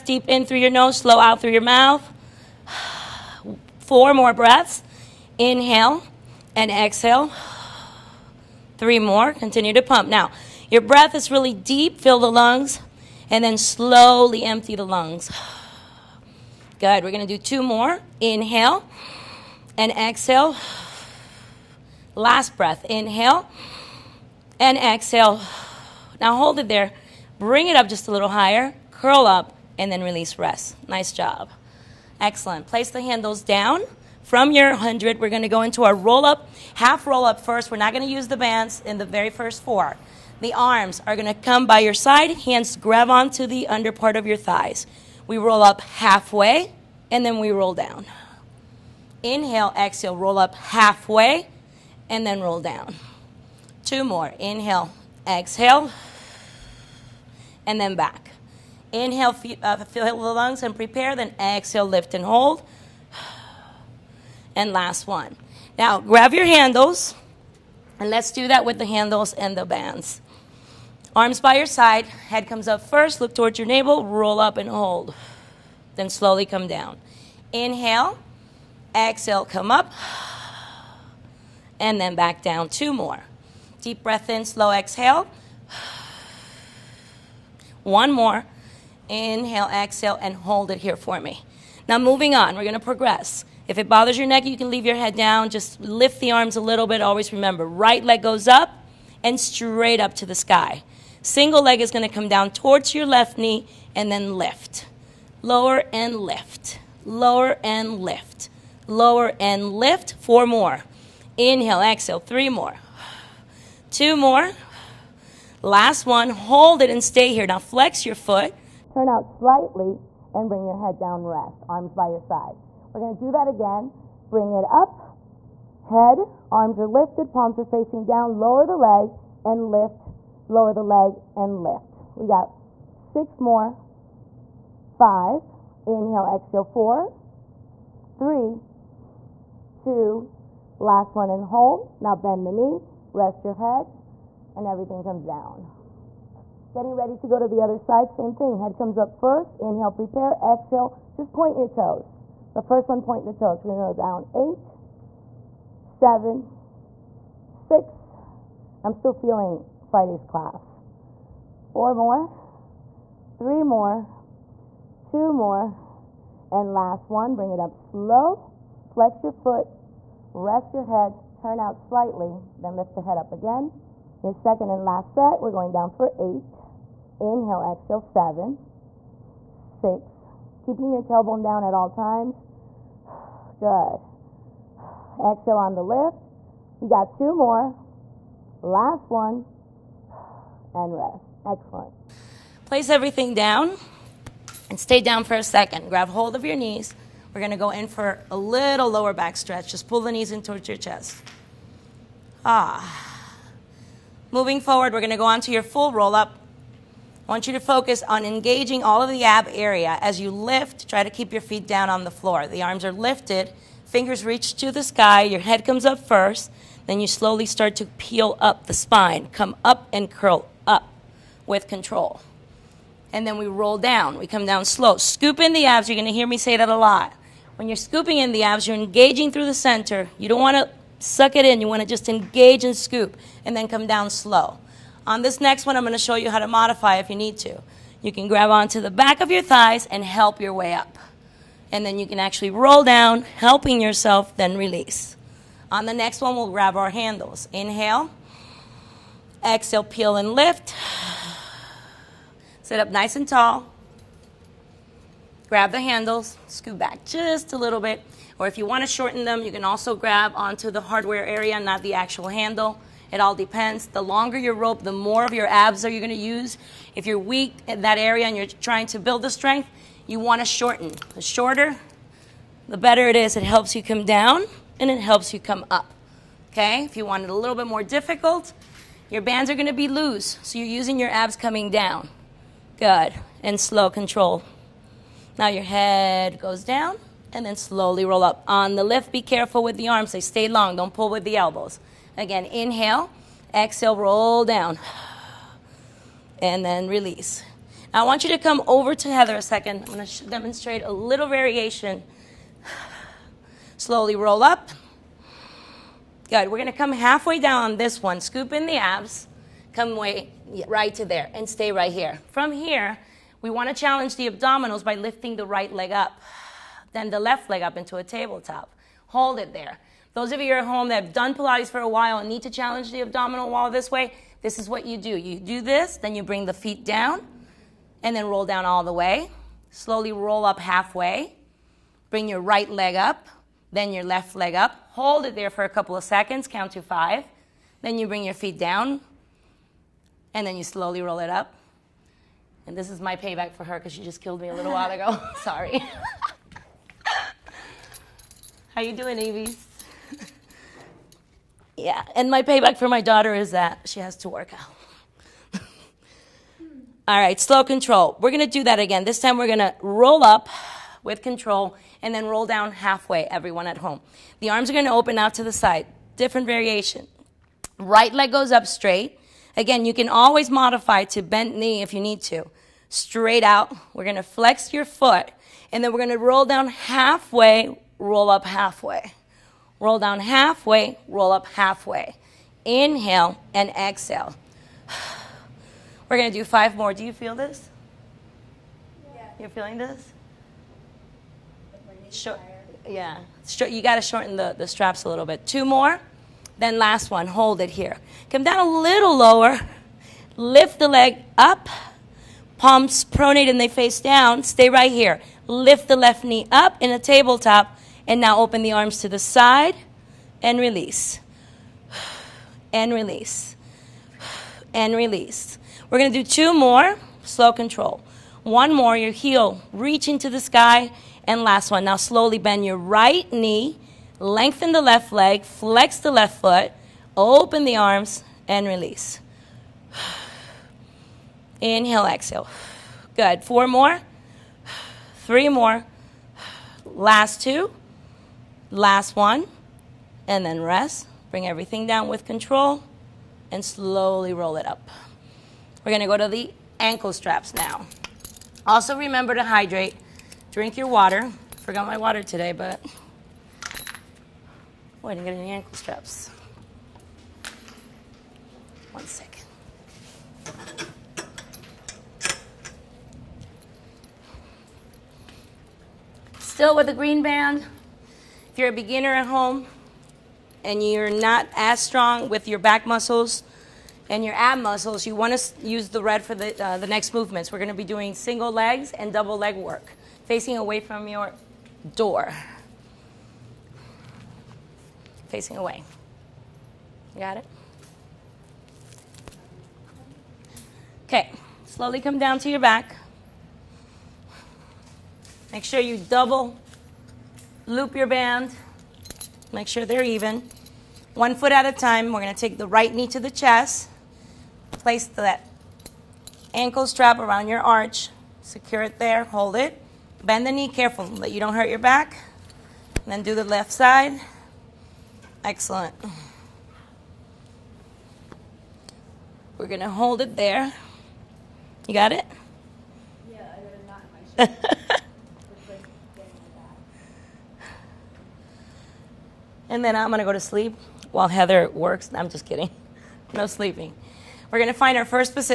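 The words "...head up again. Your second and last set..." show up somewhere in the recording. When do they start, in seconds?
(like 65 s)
172 s.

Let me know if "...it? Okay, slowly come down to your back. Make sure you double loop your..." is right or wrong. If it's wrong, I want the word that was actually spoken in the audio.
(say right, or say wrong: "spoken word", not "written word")
right.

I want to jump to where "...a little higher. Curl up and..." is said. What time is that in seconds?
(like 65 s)
28 s.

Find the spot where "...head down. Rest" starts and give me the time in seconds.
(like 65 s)
120 s.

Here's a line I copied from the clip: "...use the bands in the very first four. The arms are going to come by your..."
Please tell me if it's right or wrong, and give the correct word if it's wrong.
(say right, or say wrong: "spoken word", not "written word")
right.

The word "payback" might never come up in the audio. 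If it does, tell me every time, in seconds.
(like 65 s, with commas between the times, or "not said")
343 s, 352 s.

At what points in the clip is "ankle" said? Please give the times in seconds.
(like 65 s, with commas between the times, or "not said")
446 s, 455 s, 506 s.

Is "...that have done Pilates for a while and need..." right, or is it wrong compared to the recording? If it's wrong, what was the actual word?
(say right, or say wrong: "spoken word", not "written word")
right.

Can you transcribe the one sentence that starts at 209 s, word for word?
As you lift, try to keep your feet down on the floor.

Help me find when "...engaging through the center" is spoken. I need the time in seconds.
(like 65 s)
228 s.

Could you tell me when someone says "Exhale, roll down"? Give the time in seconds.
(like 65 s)
293 s.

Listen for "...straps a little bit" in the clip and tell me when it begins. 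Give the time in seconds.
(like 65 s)
394 s.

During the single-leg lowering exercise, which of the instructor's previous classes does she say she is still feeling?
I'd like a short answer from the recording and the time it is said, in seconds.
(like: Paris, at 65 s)
Friday's class, at 159 s.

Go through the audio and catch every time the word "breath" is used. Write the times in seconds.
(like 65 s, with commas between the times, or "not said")
4 s, 10 s, 22 s, 84 s.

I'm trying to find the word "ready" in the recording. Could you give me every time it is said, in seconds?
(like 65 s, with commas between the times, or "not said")
146 s.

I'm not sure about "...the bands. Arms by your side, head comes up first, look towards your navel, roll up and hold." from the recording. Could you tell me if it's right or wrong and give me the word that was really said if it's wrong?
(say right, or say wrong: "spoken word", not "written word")
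right.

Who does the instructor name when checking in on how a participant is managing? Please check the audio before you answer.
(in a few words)
Evie.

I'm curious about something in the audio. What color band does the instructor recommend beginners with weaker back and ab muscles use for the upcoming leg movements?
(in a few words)
red.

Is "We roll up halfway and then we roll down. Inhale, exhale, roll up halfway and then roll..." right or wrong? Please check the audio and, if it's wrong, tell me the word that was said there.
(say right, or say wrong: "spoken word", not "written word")
right.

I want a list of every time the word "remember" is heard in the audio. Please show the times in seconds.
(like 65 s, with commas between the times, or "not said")
97 s, 448 s.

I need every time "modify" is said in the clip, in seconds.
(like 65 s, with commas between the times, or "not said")
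236 s, 370 s.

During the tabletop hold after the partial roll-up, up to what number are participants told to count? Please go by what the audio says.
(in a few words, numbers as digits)
5.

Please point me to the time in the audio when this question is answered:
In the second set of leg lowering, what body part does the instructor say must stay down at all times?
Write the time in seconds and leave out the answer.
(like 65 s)
181 s.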